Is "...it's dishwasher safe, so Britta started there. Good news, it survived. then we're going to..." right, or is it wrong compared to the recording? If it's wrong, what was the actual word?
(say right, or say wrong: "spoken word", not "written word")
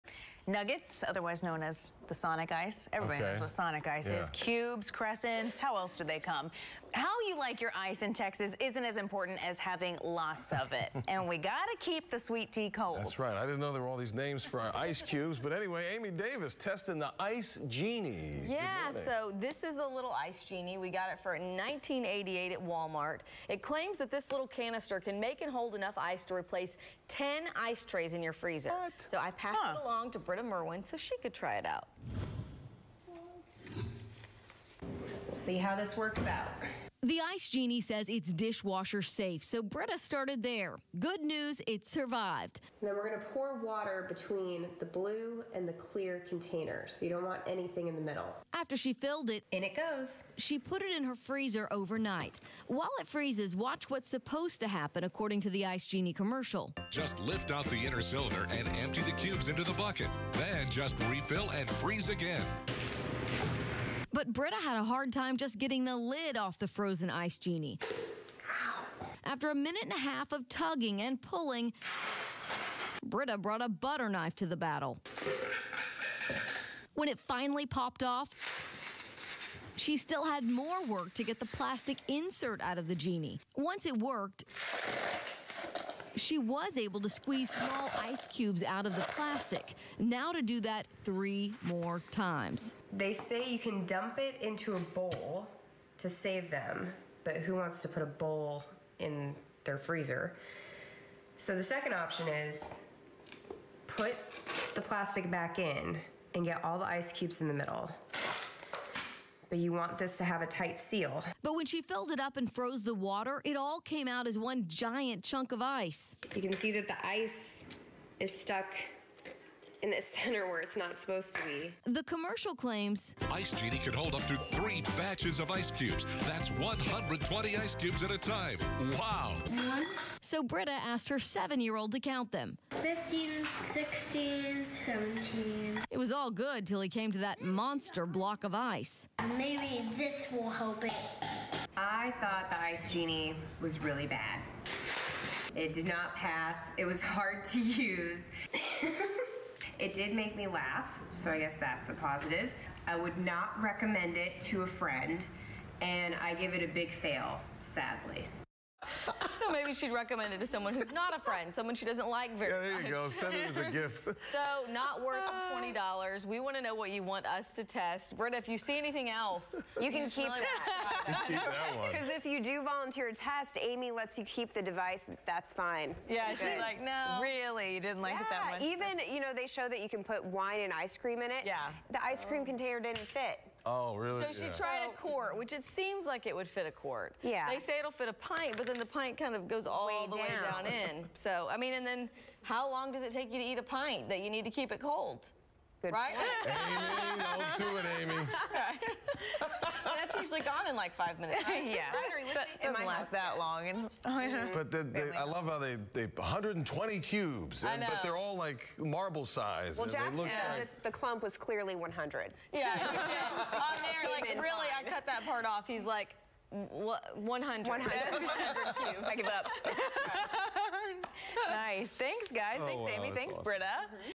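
right.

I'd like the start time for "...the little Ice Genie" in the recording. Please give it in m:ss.
0:19.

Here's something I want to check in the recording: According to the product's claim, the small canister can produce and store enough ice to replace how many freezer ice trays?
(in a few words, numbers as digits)
10.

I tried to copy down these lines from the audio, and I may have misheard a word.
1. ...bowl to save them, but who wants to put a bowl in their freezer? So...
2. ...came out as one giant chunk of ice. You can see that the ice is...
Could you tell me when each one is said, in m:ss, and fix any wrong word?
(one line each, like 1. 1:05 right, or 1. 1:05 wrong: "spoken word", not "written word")
1. 1:34 right
2. 1:53 right.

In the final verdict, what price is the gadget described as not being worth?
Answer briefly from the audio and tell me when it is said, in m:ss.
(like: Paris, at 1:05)
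$20, at 2:45.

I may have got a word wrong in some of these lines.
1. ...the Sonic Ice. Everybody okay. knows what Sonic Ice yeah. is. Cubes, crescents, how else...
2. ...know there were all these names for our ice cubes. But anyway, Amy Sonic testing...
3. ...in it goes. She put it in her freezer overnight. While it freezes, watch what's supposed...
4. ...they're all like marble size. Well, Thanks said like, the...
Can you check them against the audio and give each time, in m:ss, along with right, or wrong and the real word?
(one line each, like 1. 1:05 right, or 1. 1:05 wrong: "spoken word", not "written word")
1. 0:02 right
2. 0:13 wrong: "Davis", not "Sonic"
3. 0:49 right
4. 3:28 wrong: "Jack", not "Thanks".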